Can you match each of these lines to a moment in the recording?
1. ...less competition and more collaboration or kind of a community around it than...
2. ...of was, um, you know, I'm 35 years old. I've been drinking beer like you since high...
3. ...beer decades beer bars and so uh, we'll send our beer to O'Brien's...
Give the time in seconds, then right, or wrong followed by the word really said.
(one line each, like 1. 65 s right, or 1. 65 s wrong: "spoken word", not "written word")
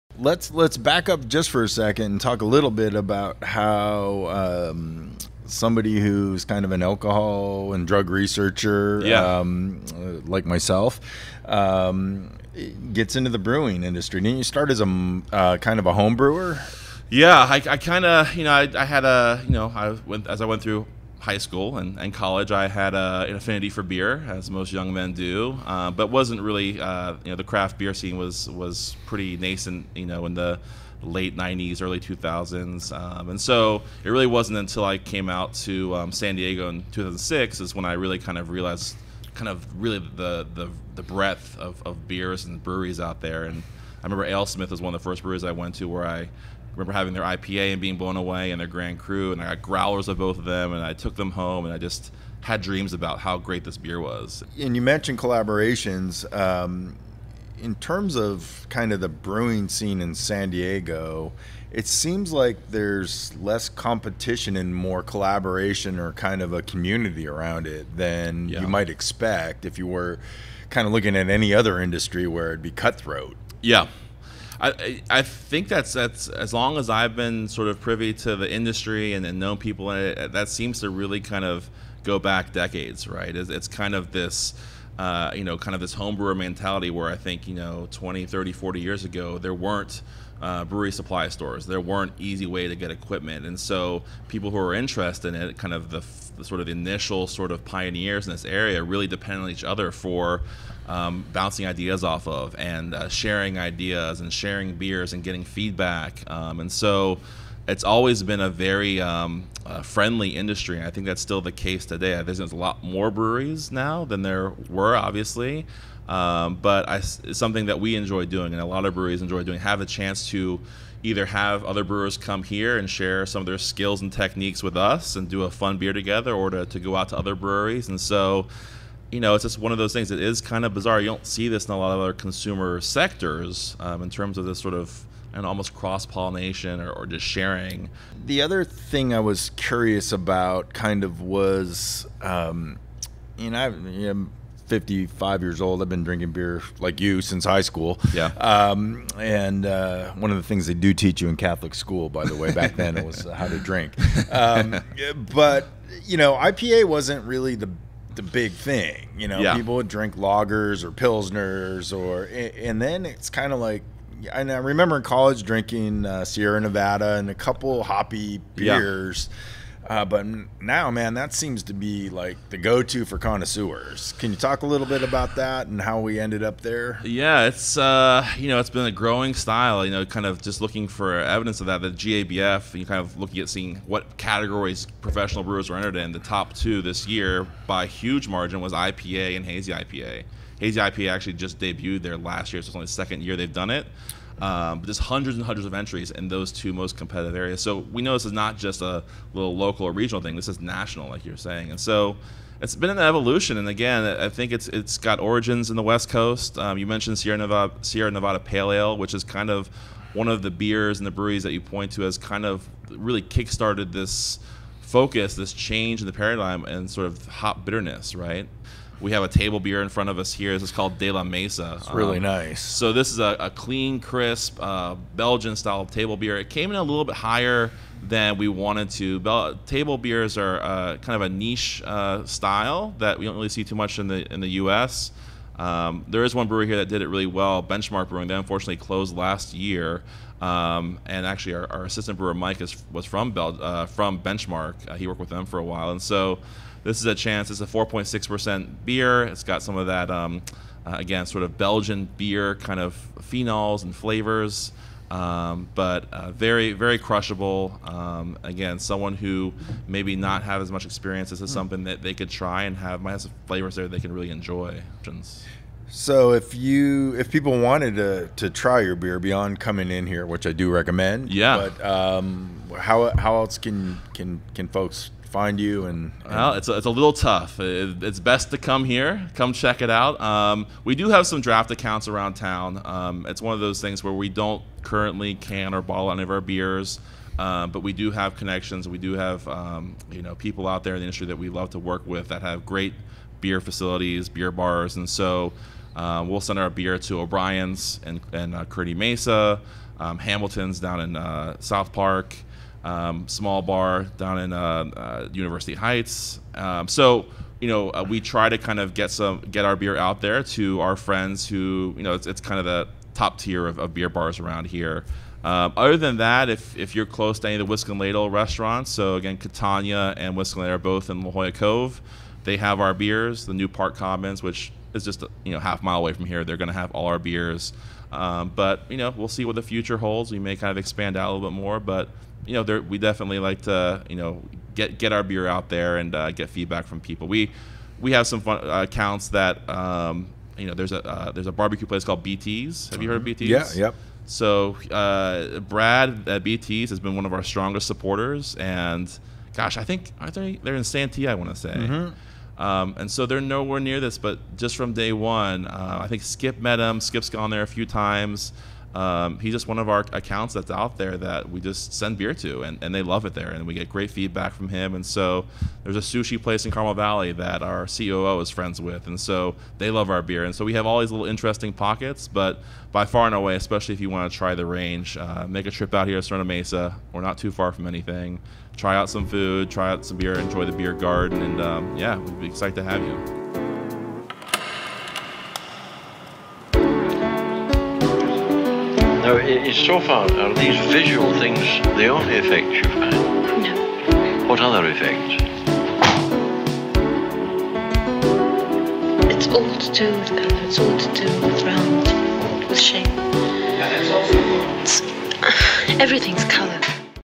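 1. 63 s right
2. 141 s wrong: "55", not "35"
3. 293 s wrong: "facilities", not "decades".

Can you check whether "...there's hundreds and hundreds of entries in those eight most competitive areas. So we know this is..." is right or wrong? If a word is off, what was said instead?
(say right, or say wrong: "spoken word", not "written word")
wrong: "two", not "eight".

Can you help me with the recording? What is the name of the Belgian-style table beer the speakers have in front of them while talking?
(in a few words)
De La Mesa.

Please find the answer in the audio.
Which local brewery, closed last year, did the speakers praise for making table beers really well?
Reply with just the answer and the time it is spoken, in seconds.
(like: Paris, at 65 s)
Benchmark Brewing, at 237 s.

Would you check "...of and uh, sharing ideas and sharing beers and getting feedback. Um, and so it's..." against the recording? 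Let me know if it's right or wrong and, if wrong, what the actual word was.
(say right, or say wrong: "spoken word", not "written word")
right.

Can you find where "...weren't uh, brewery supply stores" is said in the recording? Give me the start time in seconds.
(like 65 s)
89 s.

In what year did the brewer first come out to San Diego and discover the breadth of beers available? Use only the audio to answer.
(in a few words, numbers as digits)
2006.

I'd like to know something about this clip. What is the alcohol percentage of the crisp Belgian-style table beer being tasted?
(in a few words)
4.6%.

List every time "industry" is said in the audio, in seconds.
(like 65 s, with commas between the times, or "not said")
13 s, 71 s, 78 s, 110 s, 291 s.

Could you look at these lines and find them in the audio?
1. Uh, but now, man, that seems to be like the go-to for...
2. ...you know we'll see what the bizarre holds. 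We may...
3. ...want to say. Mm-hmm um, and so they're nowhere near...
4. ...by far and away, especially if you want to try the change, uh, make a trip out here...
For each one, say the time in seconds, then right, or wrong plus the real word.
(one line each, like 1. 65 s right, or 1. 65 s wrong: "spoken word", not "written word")
1. 169 s right
2. 328 s wrong: "future", not "bizarre"
3. 351 s right
4. 372 s wrong: "range", not "change".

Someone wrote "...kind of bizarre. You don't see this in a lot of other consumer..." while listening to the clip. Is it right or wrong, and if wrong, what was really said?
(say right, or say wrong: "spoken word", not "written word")
right.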